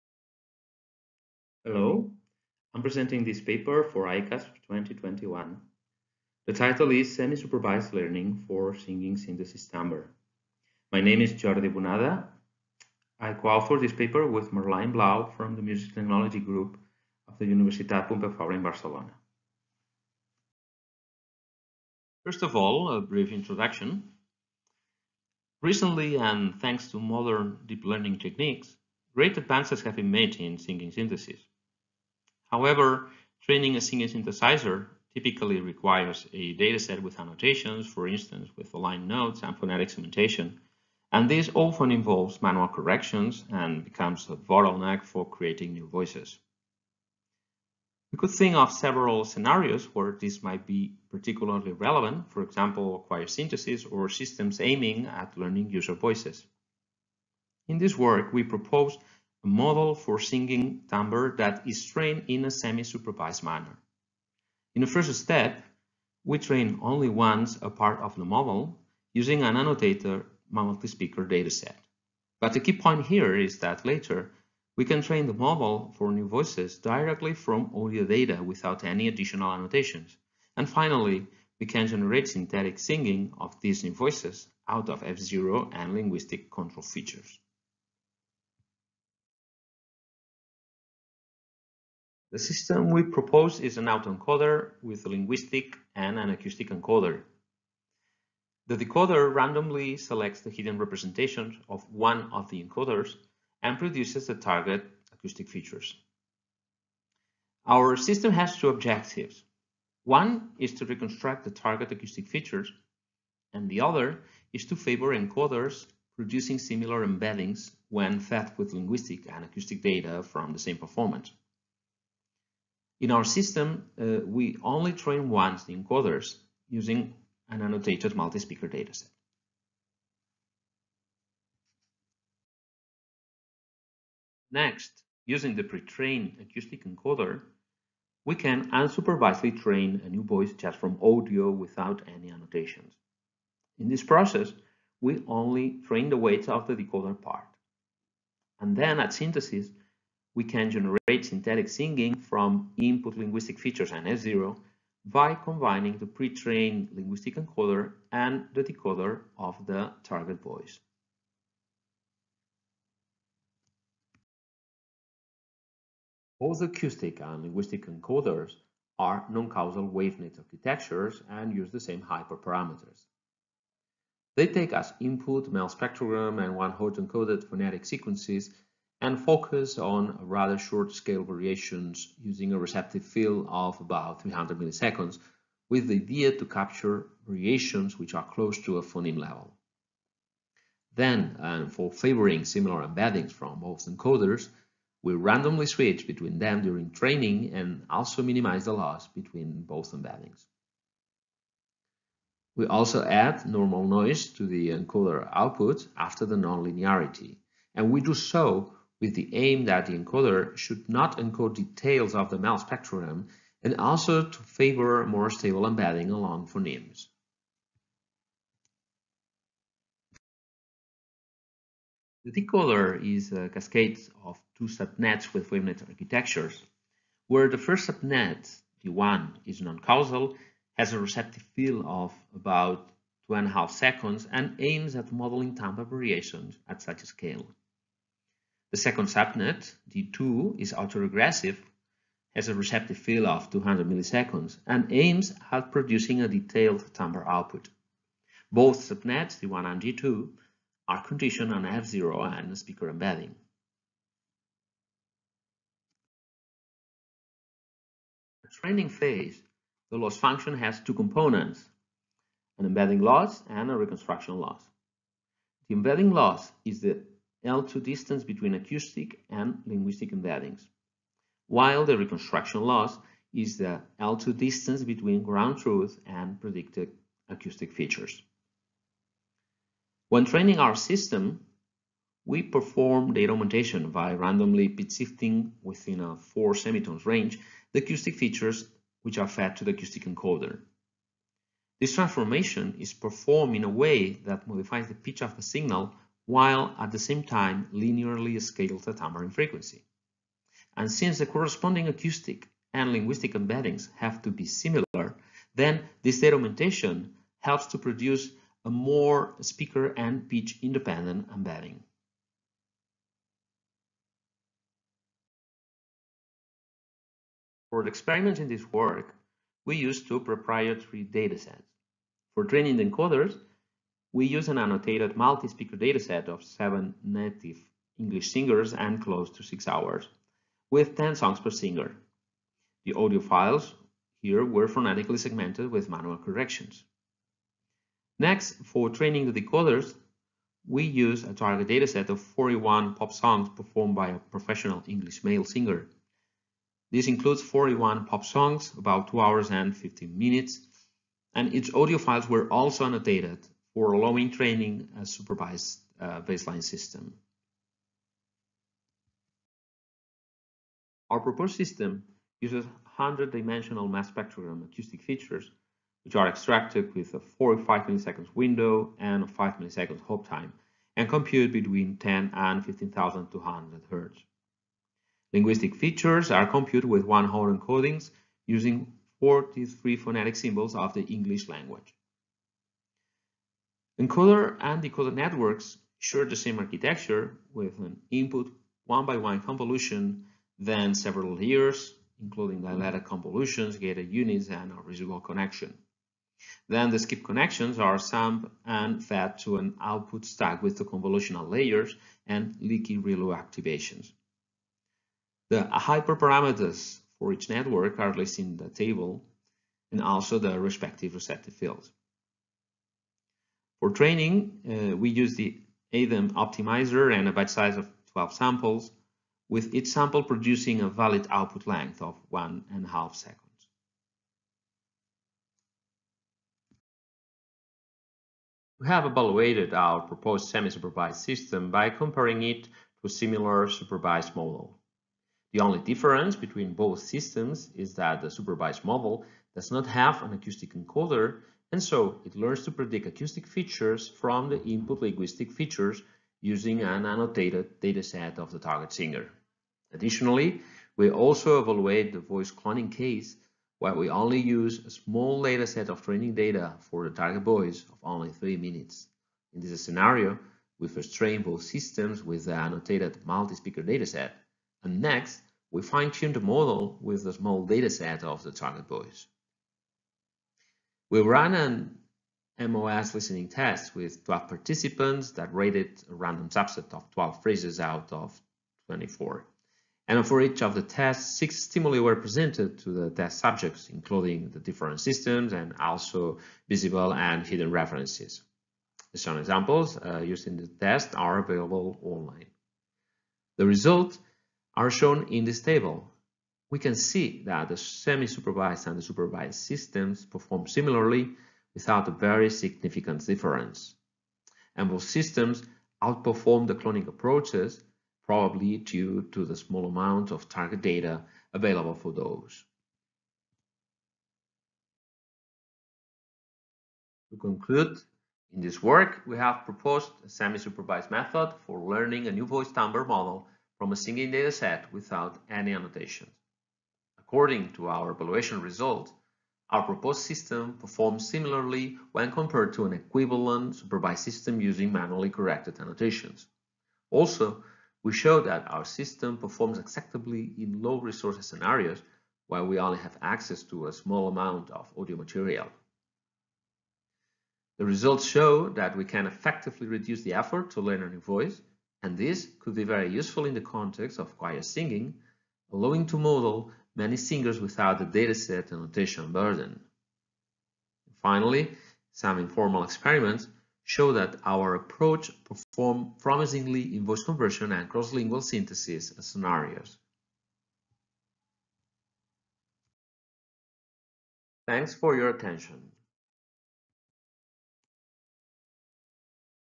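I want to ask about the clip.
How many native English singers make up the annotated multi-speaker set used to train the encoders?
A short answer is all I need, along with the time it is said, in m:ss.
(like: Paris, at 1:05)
7, at 5:26.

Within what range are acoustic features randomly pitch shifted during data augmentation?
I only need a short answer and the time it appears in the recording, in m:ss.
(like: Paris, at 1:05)
4 semitones, at 4:46.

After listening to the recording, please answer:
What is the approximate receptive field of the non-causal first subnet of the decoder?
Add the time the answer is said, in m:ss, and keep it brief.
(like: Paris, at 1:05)
2.5 seconds, at 3:53.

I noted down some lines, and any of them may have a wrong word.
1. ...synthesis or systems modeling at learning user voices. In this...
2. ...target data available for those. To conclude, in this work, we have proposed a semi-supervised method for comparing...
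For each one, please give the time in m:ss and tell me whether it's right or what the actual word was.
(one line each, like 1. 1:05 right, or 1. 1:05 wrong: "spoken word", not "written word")
1. 0:53 wrong: "aiming", not "modeling"
2. 8:30 wrong: "learning", not "comparing".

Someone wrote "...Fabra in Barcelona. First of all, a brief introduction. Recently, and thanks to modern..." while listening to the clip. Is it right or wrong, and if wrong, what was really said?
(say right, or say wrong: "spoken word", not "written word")
right.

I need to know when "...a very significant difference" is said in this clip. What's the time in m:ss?
8:22.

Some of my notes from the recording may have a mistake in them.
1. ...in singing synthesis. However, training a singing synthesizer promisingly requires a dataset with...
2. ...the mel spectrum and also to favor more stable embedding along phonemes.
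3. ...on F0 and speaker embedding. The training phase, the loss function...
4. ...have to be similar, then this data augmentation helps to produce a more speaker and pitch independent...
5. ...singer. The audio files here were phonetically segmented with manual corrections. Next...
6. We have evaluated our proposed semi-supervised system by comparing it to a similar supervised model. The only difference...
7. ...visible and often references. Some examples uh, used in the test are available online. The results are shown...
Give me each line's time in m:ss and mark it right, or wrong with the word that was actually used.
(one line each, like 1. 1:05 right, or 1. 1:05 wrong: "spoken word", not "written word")
1. 0:30 wrong: "typically", not "promisingly"
2. 3:32 right
3. 4:11 right
4. 5:03 right
5. 5:31 right
6. 7:08 right
7. 8:06 wrong: "hidden", not "often".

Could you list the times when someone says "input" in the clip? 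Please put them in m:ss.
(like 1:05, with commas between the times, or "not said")
2:32, 2:54, 6:28, 7:24.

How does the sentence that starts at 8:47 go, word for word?
According to our evaluation result, our proposed system performs similarly when compared to an equivalent supervised system using manually corrected annotations.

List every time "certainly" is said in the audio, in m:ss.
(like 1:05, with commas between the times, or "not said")
not said.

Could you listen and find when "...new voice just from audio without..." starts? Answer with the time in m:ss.
2:20.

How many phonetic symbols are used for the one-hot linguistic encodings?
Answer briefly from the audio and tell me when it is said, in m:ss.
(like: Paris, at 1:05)
43, at 6:19.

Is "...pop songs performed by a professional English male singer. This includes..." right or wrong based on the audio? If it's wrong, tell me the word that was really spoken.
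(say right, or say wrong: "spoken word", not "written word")
right.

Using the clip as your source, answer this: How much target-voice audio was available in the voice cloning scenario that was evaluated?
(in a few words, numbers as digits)
3 minutes.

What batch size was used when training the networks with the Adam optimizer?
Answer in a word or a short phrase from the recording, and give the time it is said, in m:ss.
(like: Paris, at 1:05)
12, at 6:58.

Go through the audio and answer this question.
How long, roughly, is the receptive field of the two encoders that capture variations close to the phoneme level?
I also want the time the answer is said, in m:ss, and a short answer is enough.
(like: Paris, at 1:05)
300 milliseconds, at 3:04.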